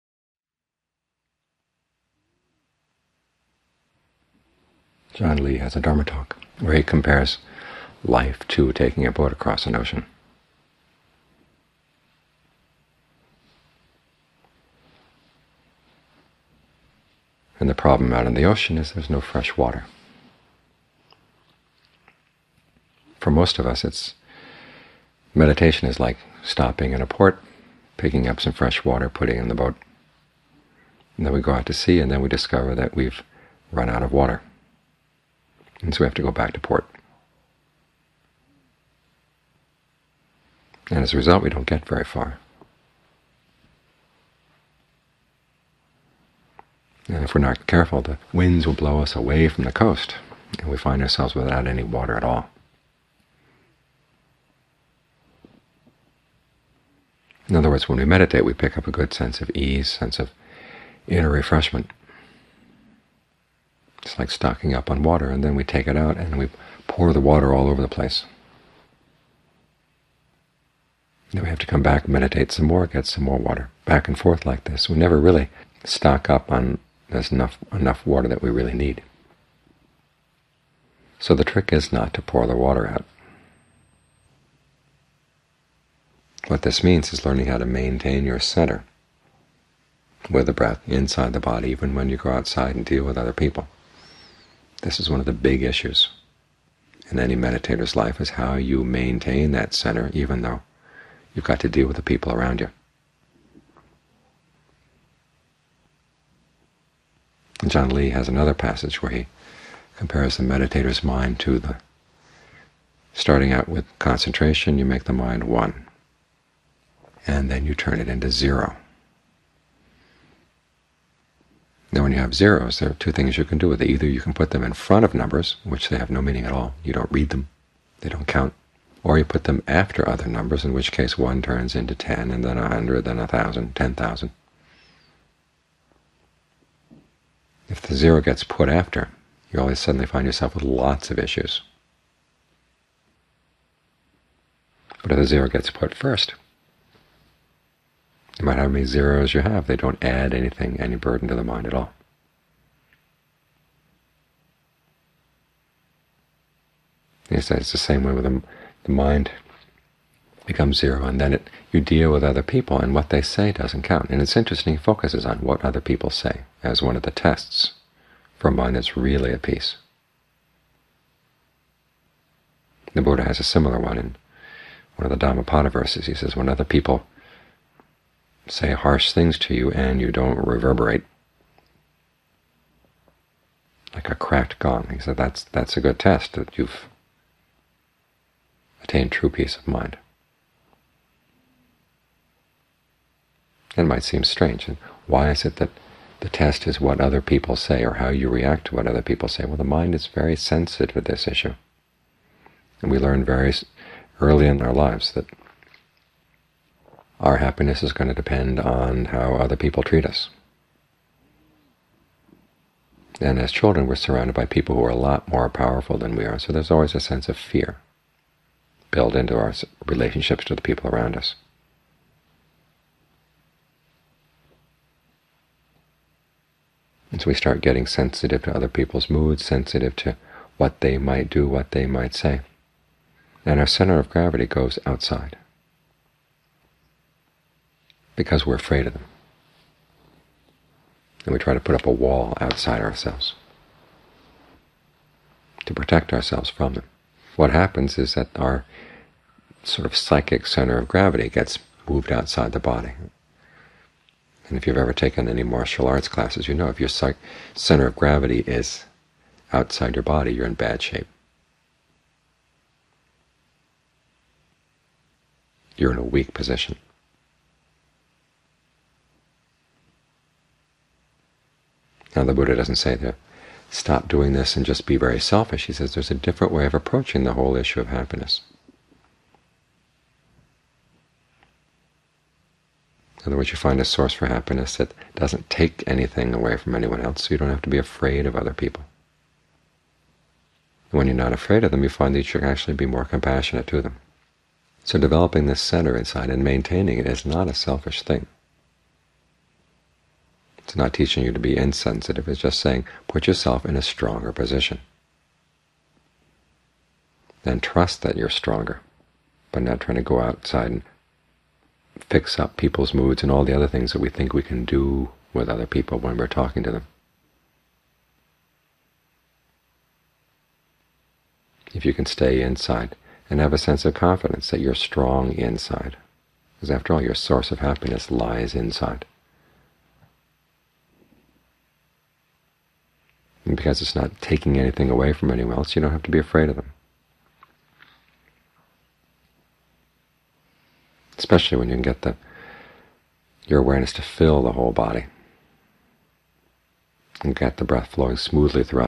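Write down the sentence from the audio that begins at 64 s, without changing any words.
It's like stocking up on water, and then we take it out and we pour the water all over the place.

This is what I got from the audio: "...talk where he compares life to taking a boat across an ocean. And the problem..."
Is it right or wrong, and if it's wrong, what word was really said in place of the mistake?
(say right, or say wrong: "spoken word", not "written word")
right.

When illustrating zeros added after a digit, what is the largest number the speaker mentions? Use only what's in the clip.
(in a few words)
10,000.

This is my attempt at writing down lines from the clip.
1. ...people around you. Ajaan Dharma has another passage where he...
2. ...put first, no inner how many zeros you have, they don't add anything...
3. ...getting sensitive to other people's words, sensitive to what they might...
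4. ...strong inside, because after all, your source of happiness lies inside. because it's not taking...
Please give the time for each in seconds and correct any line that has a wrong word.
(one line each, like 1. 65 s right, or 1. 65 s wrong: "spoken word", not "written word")
1. 102 s wrong: "Lee", not "Dharma"
2. 145 s wrong: "matter", not "inner"
3. 227 s wrong: "moods", not "words"
4. 324 s right.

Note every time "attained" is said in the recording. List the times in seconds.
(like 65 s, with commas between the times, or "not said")
188 s.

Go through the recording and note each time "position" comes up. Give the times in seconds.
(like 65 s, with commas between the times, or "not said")
266 s, 304 s.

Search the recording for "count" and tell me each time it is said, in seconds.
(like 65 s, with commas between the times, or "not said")
128 s, 163 s.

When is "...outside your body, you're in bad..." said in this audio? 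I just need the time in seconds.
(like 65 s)
259 s.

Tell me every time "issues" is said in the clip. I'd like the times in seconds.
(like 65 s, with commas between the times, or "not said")
95 s, 141 s, 201 s, 277 s.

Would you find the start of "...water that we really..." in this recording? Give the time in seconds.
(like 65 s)
78 s.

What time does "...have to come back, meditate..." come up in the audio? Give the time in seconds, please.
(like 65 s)
71 s.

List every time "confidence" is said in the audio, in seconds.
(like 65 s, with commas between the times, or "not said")
323 s.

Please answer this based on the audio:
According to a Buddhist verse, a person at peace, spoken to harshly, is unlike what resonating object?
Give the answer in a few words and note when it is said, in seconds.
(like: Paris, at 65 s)
a cracked gong, at 184 s.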